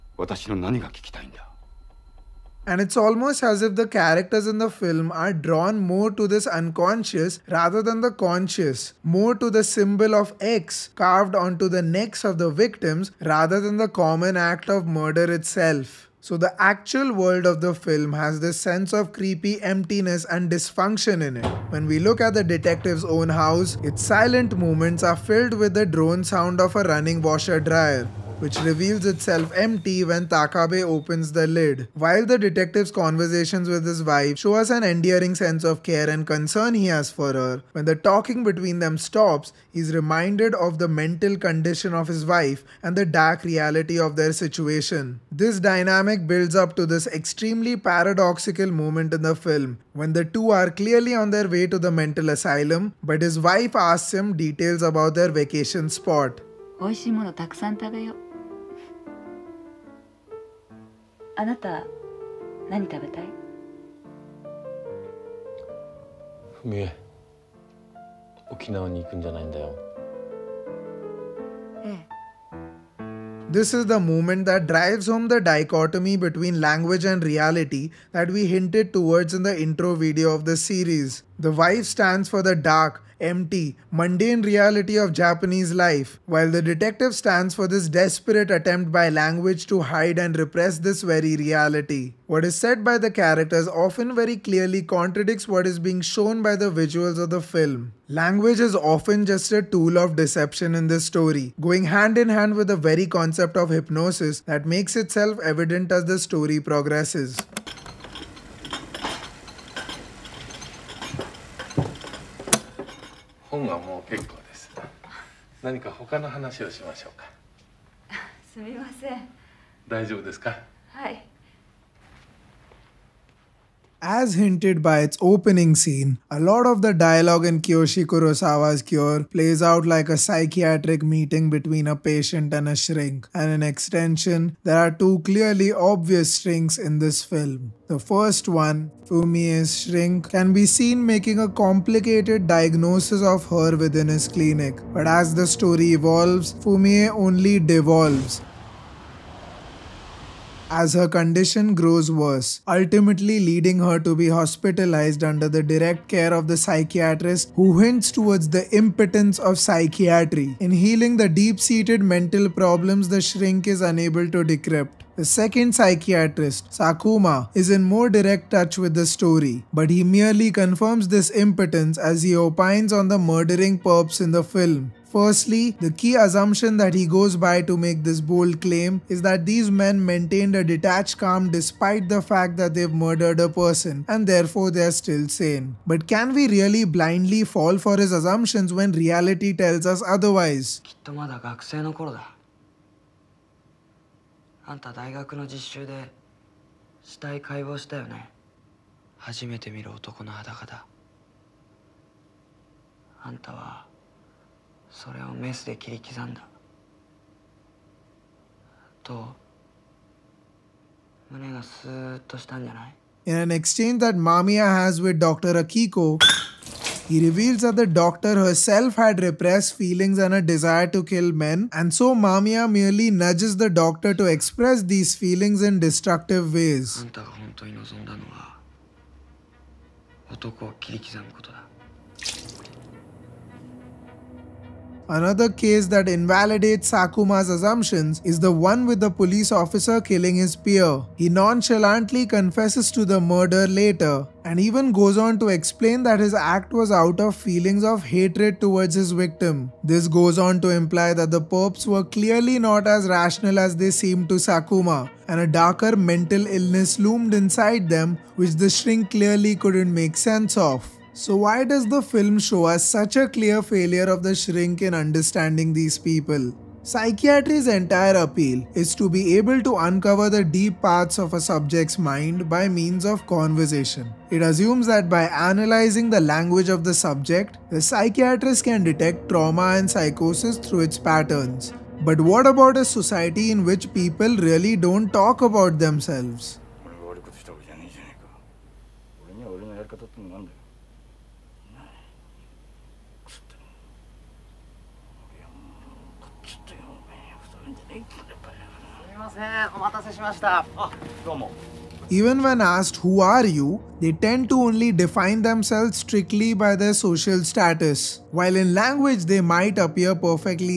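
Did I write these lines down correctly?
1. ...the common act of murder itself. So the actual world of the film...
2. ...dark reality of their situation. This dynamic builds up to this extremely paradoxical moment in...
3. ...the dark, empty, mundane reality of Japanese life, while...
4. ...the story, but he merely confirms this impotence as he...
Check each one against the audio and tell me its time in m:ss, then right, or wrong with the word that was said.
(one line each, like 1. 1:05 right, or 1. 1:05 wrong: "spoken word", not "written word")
1. 0:13 right
2. 0:43 right
3. 1:22 right
4. 2:48 right.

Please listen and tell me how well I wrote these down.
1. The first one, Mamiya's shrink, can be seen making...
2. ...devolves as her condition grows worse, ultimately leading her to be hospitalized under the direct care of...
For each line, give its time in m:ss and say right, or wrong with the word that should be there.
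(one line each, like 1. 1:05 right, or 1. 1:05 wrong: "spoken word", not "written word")
1. 2:17 wrong: "Fumie", not "Mamiya"
2. 2:27 right.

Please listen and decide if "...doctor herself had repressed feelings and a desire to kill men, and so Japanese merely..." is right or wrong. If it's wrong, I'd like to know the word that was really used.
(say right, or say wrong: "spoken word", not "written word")
wrong: "Mamiya", not "Japanese".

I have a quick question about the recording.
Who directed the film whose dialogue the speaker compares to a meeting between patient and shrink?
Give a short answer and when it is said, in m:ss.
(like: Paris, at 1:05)
Kiyoshi Kurosawa, at 2:07.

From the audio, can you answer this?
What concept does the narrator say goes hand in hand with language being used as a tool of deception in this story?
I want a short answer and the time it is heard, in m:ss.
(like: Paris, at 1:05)
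hypnosis, at 1:43.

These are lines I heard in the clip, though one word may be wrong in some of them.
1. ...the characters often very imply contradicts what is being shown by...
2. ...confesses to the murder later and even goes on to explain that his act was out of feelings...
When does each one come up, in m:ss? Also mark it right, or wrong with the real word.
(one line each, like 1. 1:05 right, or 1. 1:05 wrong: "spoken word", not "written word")
1. 1:32 wrong: "clearly", not "imply"
2. 4:02 right.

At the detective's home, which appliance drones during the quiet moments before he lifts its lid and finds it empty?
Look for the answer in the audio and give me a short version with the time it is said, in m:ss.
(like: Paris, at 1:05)
washer dryer, at 0:27.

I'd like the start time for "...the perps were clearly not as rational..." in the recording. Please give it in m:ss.
4:11.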